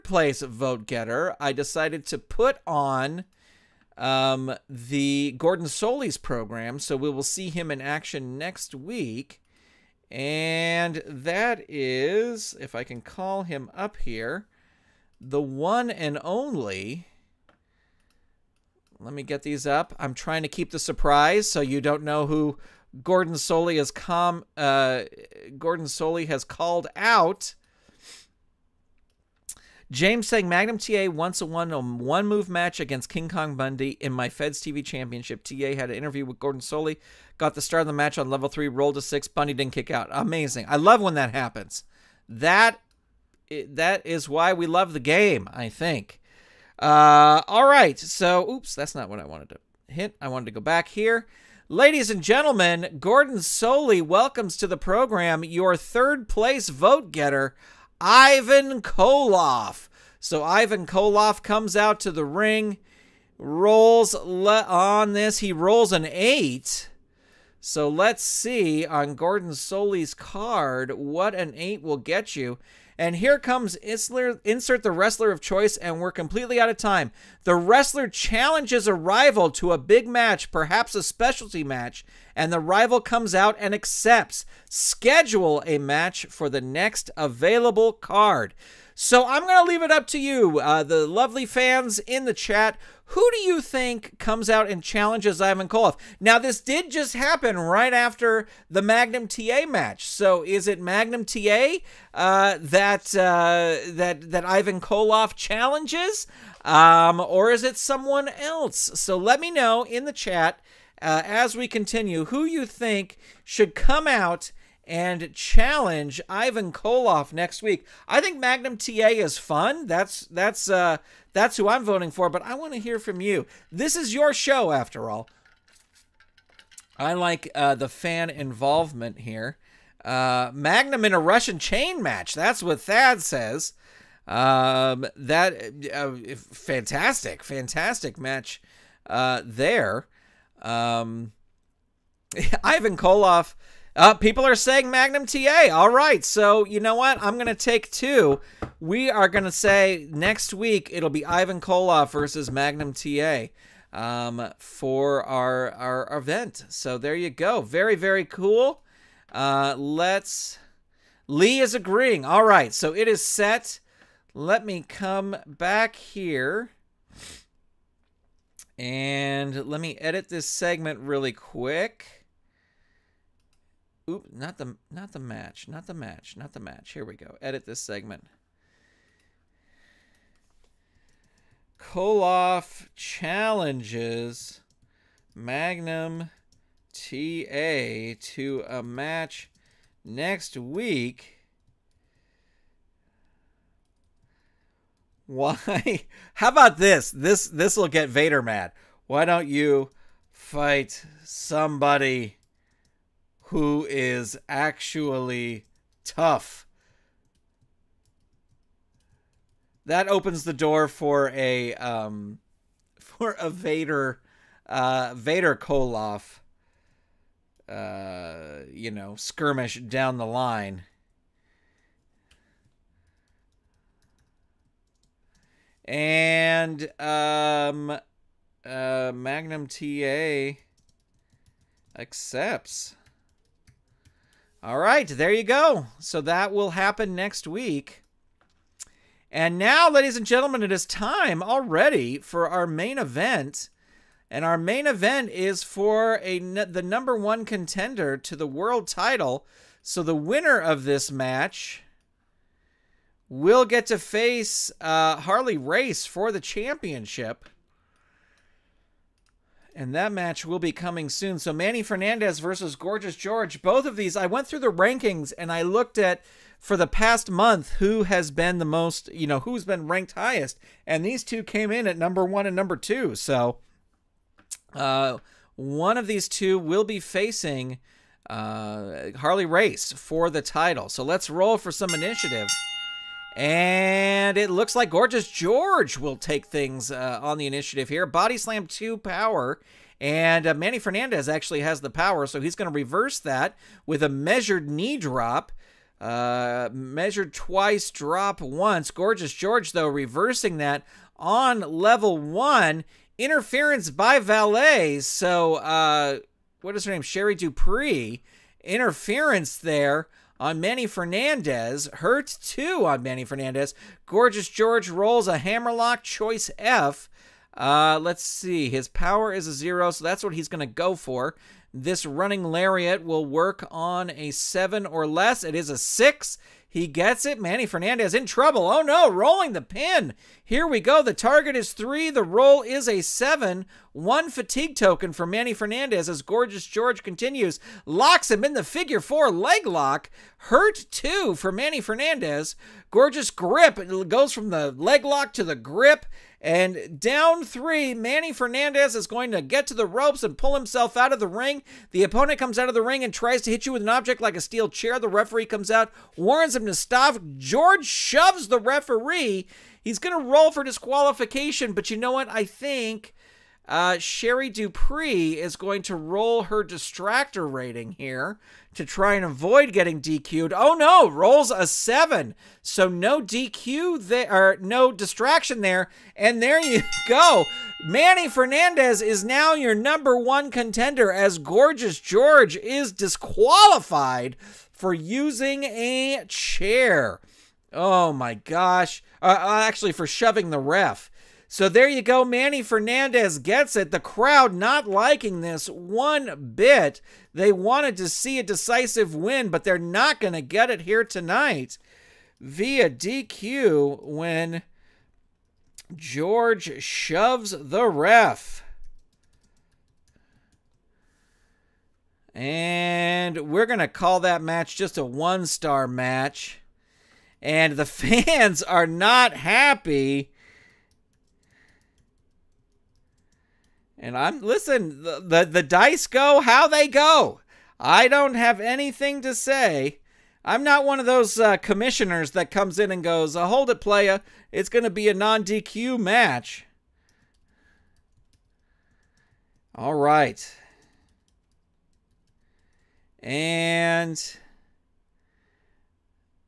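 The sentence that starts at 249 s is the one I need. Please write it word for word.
So the winner of this match will get to face uh, Harley Race for the championship.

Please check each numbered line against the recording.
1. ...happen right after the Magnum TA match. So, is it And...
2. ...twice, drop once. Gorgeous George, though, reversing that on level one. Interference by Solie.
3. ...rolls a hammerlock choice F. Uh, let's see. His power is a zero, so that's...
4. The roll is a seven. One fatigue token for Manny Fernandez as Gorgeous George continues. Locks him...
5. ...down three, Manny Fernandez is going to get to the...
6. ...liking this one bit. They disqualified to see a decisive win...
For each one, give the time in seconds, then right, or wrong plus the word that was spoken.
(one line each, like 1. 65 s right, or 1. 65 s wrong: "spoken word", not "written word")
1. 97 s wrong: "Magnum", not "And"
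2. 297 s wrong: "Valet", not "Solie"
3. 314 s right
4. 332 s right
5. 346 s right
6. 394 s wrong: "wanted", not "disqualified".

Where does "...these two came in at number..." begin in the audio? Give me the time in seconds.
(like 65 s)
271 s.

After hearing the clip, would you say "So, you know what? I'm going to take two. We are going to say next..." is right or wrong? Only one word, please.
right.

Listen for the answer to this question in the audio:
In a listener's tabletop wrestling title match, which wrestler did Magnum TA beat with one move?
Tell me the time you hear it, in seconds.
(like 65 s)
33 s.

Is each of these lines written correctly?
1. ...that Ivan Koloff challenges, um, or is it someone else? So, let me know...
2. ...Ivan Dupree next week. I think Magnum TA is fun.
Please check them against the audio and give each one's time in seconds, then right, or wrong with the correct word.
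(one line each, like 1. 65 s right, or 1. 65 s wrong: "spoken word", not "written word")
1. 104 s right
2. 116 s wrong: "Koloff", not "Dupree".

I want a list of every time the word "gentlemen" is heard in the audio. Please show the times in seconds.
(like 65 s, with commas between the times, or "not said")
52 s, 240 s.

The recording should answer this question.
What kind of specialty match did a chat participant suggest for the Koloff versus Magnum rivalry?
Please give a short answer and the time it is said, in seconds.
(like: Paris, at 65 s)
Russian chain match, at 131 s.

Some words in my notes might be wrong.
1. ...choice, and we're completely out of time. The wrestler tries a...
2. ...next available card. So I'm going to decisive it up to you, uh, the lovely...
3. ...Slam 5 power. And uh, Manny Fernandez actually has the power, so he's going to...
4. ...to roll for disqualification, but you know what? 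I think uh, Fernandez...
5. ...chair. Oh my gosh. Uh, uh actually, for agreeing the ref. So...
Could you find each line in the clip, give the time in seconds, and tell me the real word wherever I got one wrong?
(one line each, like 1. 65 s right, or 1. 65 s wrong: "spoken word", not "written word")
1. 75 s wrong: "challenges", not "tries"
2. 86 s wrong: "leave", not "decisive"
3. 288 s wrong: "2", not "5"
4. 360 s wrong: "Sherry", not "Fernandez"
5. 386 s wrong: "shoving", not "agreeing".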